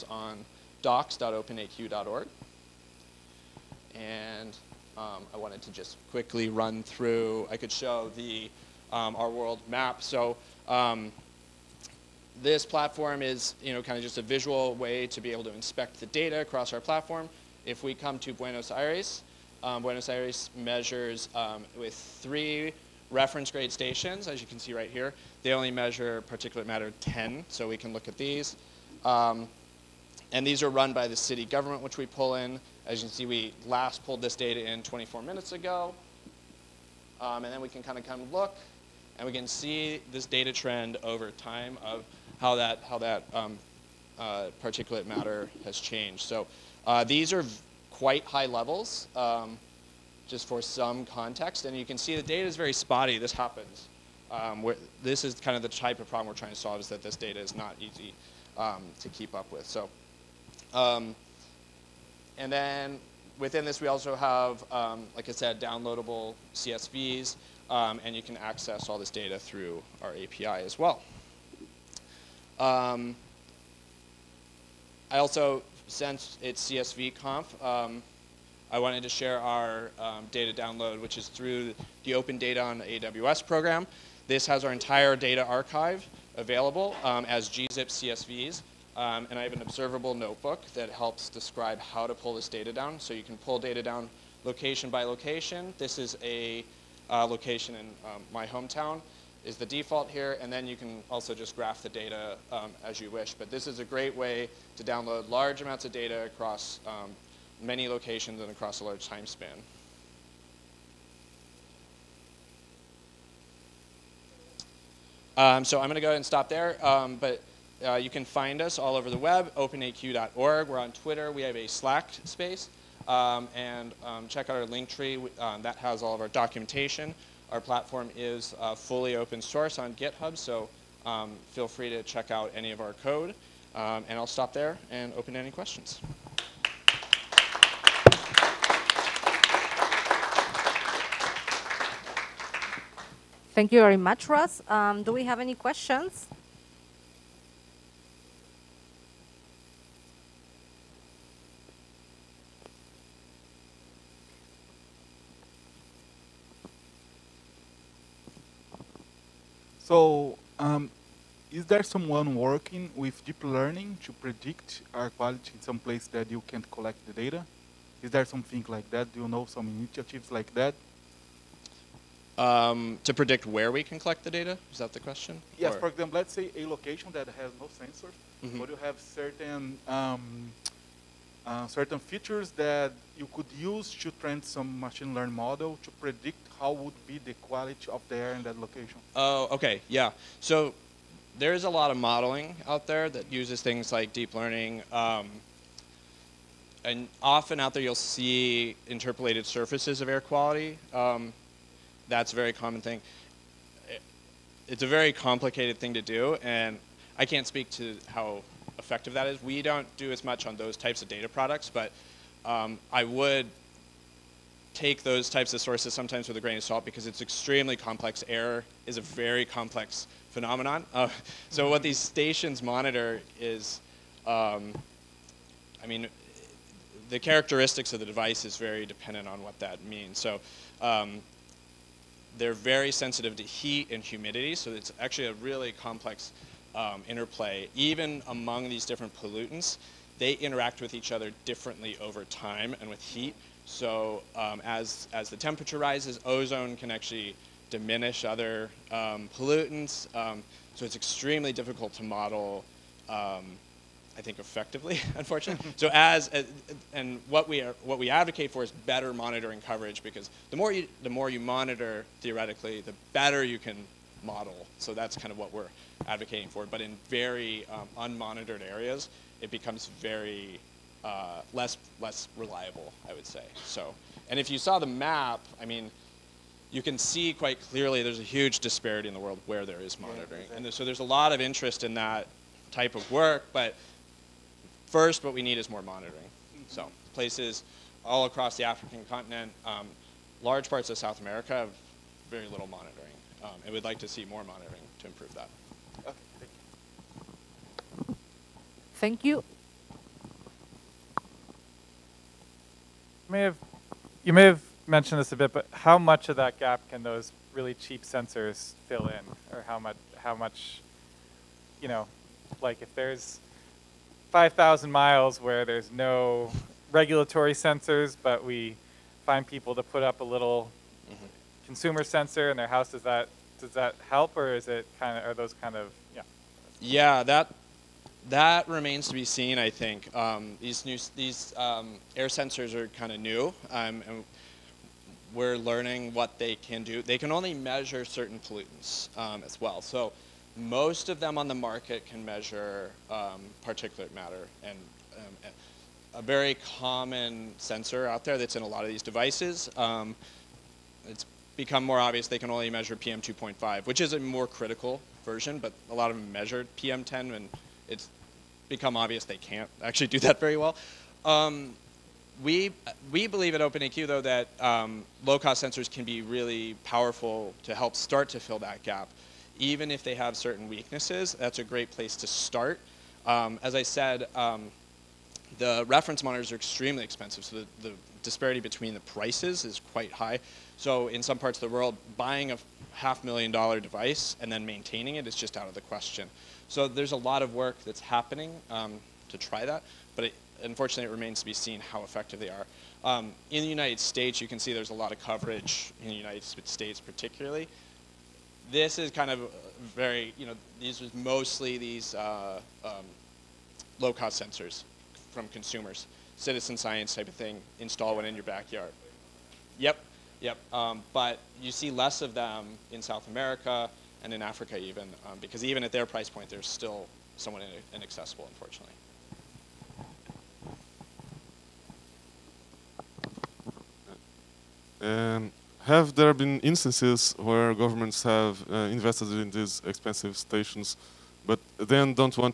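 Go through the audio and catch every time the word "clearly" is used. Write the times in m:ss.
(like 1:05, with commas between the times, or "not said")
4:37.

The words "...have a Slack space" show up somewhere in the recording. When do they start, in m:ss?
2:01.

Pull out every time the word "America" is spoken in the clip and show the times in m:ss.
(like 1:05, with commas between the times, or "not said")
4:51, 6:53.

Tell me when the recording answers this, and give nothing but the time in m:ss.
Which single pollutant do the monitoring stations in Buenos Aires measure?
0:26.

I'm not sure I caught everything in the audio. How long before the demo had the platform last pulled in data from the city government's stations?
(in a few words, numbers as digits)
24 minutes.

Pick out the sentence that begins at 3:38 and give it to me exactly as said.
Error is a very complex phenomenon.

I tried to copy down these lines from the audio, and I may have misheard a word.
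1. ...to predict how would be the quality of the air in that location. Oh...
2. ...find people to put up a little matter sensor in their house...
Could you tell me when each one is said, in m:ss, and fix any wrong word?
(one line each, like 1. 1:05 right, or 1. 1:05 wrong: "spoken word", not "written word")
1. 3:05 right
2. 5:19 wrong: "consumer", not "matter".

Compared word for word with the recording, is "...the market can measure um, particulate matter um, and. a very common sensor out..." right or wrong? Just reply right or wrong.
right.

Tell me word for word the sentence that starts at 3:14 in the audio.
Um, and often out there you'll see interpolated surfaces of air quality.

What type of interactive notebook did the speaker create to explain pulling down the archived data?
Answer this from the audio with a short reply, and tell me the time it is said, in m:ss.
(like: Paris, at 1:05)
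Observable, at 1:29.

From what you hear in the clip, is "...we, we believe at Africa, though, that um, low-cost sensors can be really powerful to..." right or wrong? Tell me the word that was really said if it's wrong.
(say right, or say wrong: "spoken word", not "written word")
wrong: "OpenAQ", not "Africa".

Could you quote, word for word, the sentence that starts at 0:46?
So uh, these are quite high levels, um, just for some context.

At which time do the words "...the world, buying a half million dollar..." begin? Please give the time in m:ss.
6:21.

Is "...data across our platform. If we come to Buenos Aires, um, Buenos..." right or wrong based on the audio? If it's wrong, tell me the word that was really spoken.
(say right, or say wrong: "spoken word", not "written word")
right.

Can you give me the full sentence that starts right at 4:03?
So um, as, as the temperature rises, ozone can actually diminish other um, pollutants.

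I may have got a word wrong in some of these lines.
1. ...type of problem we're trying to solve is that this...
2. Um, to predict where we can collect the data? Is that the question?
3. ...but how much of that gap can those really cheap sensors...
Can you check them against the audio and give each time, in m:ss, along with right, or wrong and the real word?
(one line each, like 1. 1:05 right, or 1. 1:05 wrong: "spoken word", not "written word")
1. 0:55 right
2. 2:52 right
3. 5:05 right.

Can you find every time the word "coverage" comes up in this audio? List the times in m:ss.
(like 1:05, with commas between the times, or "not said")
4:19, 6:35.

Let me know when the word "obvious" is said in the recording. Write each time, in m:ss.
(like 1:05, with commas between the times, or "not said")
5:51, 5:58.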